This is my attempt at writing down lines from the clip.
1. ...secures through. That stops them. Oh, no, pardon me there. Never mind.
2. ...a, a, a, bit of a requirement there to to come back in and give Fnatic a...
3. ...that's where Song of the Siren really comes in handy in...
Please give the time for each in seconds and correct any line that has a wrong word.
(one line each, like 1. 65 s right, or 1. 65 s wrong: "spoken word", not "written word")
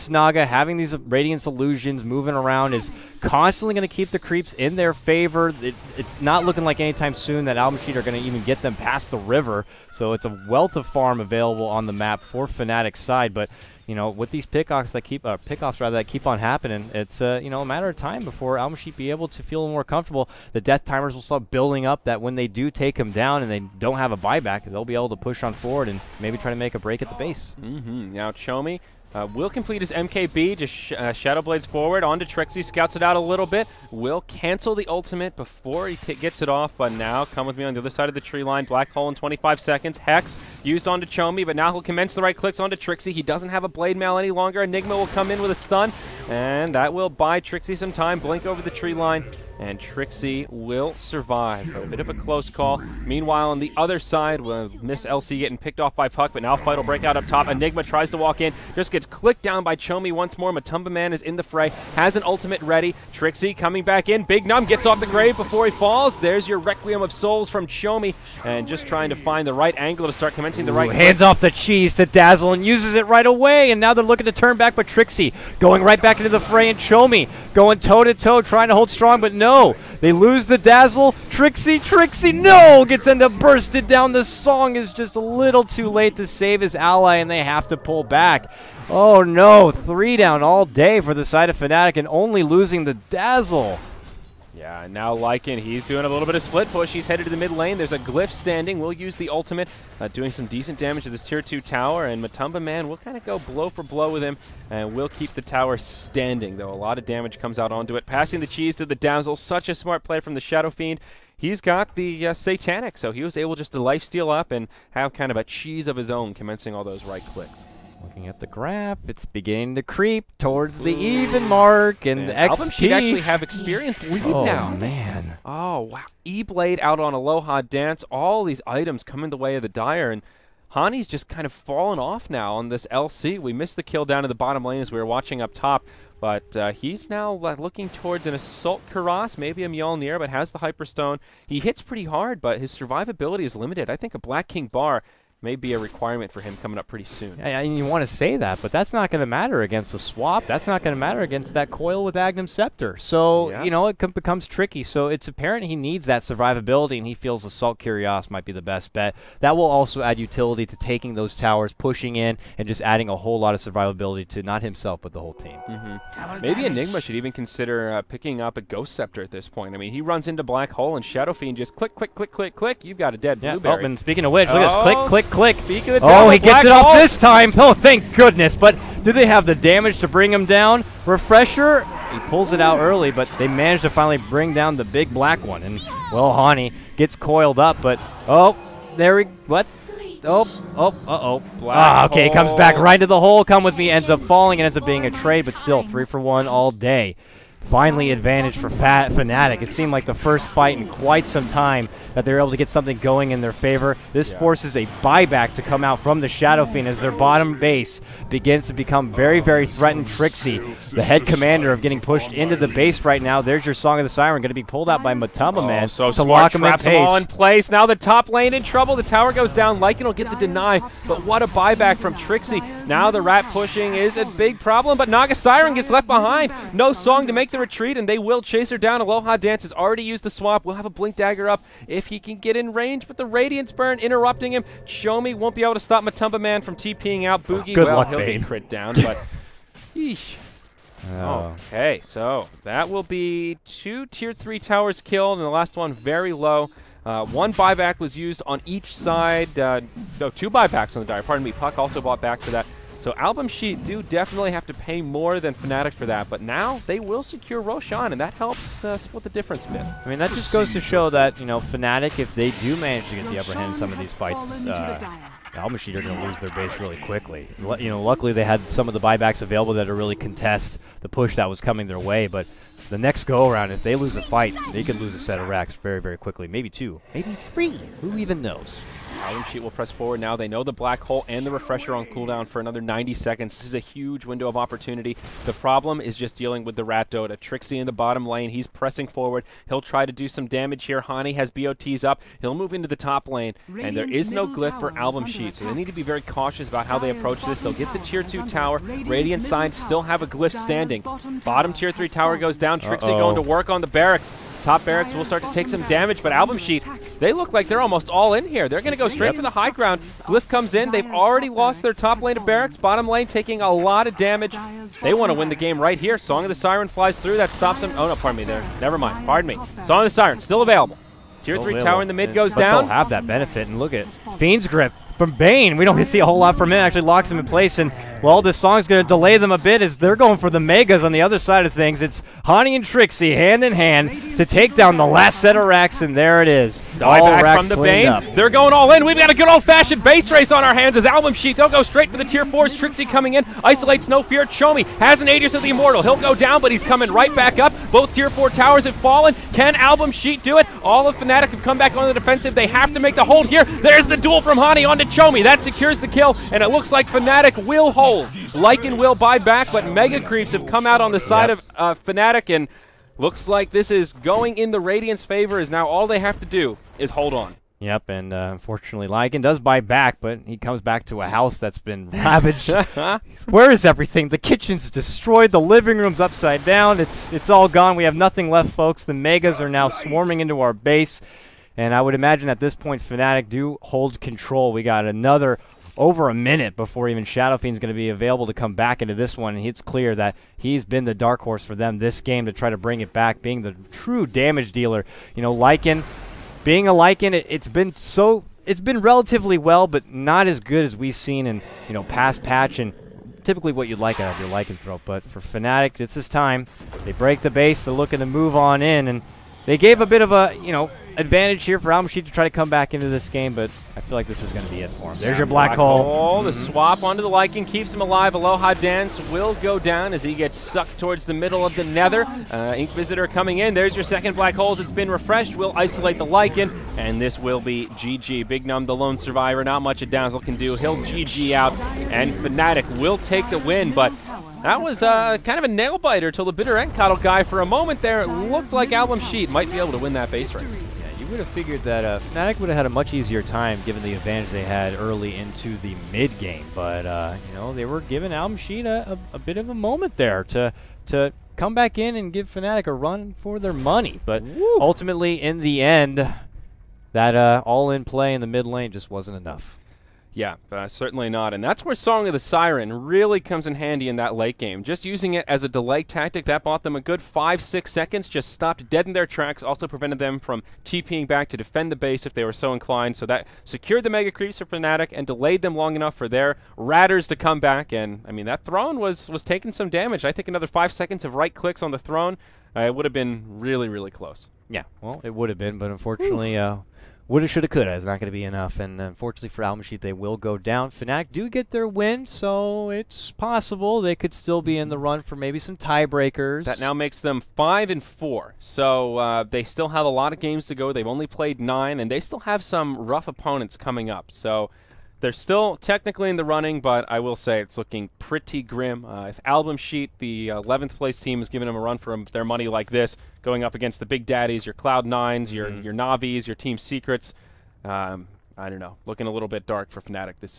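1. 316 s wrong: "flies", not "secures"
2. 448 s wrong: "moment", not "requirement"
3. 461 s right.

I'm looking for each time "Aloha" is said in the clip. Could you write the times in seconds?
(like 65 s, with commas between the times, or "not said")
127 s, 229 s, 418 s.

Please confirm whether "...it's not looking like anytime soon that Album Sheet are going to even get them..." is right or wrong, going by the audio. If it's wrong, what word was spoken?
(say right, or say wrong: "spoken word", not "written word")
right.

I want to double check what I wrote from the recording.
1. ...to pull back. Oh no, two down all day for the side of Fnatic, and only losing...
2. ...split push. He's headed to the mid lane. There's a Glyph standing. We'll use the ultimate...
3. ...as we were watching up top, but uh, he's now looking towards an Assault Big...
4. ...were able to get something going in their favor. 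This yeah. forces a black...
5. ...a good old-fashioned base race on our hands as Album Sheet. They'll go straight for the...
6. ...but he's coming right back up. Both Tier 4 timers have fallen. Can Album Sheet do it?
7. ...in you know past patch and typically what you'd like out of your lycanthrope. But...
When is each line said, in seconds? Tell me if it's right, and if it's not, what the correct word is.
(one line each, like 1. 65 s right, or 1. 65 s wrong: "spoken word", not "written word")
1. 87 s wrong: "three", not "two"
2. 96 s right
3. 134 s wrong: "Cuirass", not "Big"
4. 202 s wrong: "buyback", not "black"
5. 339 s right
6. 346 s wrong: "towers", not "timers"
7. 401 s right.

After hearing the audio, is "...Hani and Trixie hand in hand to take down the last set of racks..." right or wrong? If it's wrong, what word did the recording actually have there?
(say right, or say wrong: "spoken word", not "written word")
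right.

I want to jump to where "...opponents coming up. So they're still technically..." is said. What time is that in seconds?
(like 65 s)
503 s.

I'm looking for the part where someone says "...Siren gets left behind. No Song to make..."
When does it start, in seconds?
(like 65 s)
225 s.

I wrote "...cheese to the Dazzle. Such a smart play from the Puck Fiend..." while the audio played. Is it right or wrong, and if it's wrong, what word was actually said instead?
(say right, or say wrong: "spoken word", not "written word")
wrong: "Shadow", not "Puck".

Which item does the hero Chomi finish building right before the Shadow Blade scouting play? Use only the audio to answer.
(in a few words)
MKB.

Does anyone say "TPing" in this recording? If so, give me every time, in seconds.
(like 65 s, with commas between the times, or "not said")
236 s, 470 s.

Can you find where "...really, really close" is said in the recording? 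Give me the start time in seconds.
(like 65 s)
483 s.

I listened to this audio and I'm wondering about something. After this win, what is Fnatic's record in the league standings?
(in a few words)
5 and 4.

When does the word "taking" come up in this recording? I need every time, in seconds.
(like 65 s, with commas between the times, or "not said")
160 s, 313 s, 479 s.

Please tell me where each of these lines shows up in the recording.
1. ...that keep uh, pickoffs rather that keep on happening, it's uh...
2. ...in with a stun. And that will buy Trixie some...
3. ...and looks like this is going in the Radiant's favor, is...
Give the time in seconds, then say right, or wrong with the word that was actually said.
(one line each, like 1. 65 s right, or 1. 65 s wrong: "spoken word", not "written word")
1. 14 s right
2. 45 s right
3. 362 s right.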